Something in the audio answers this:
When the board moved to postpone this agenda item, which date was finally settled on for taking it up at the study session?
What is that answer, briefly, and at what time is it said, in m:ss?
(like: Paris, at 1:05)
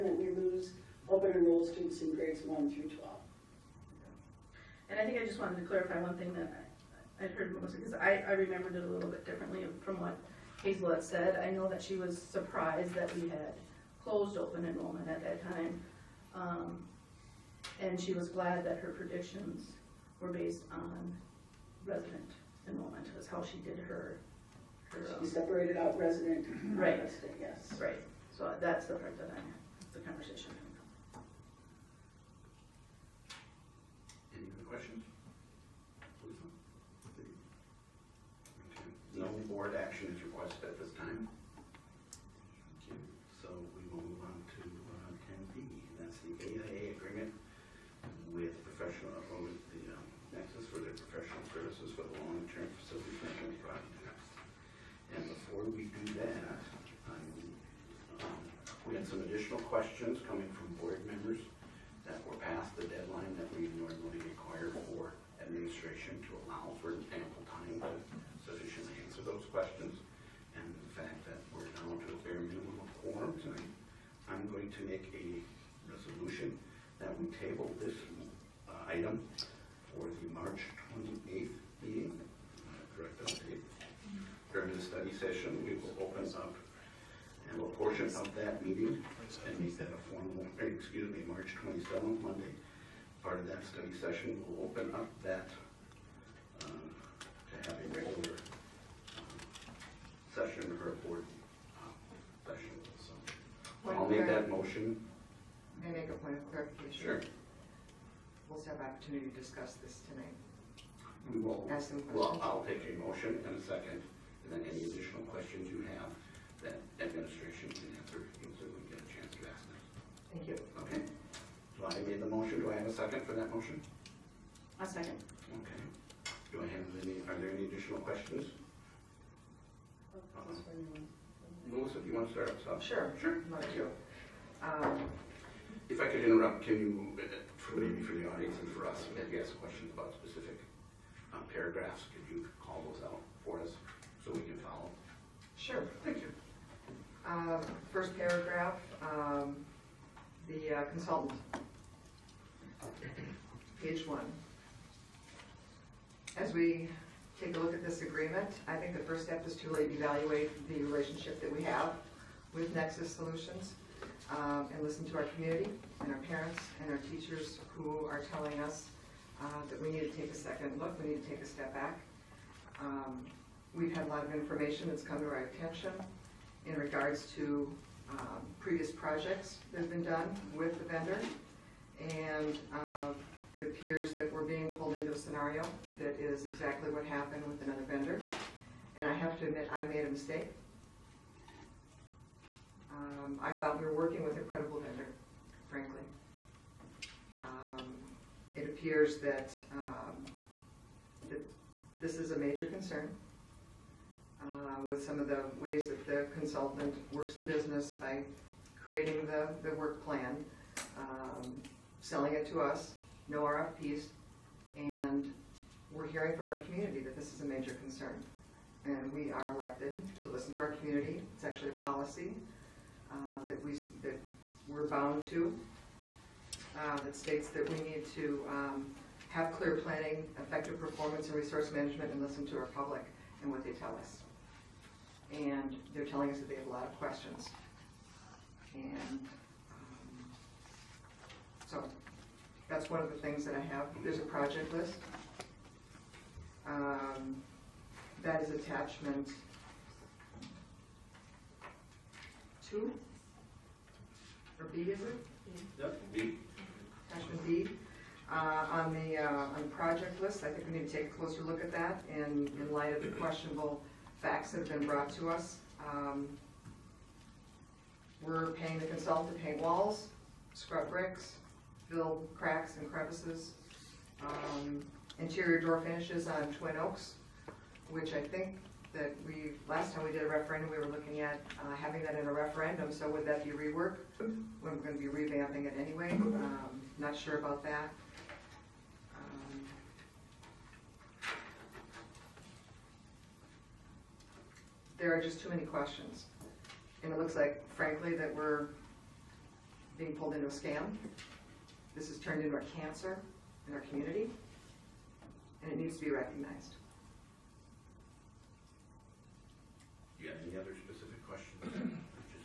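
March 27, at 1:31.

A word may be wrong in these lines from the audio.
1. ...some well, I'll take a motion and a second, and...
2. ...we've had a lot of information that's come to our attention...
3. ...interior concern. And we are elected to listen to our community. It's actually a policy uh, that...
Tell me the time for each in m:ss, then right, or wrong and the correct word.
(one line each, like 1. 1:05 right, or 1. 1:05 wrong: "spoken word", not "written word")
1. 1:51 right
2. 2:53 right
3. 3:37 wrong: "major", not "interior".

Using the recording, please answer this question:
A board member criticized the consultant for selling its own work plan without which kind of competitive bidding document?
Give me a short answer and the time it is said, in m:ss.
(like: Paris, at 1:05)
RFPs, at 3:33.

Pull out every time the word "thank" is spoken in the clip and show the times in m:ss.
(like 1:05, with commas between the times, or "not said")
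2:00, 2:13, 2:26.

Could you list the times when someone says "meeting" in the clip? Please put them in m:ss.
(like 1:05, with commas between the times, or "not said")
1:21, 1:28.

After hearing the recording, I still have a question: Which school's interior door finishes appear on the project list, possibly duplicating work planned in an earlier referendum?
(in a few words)
Twin Oaks.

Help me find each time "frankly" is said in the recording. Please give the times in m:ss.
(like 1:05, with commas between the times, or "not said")
3:15, 4:57.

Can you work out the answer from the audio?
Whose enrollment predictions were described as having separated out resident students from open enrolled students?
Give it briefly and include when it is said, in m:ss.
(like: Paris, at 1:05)
Hazel, at 0:10.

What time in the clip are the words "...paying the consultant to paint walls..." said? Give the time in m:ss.
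4:28.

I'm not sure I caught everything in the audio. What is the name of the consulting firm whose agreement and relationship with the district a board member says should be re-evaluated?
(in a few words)
Nexus Solutions.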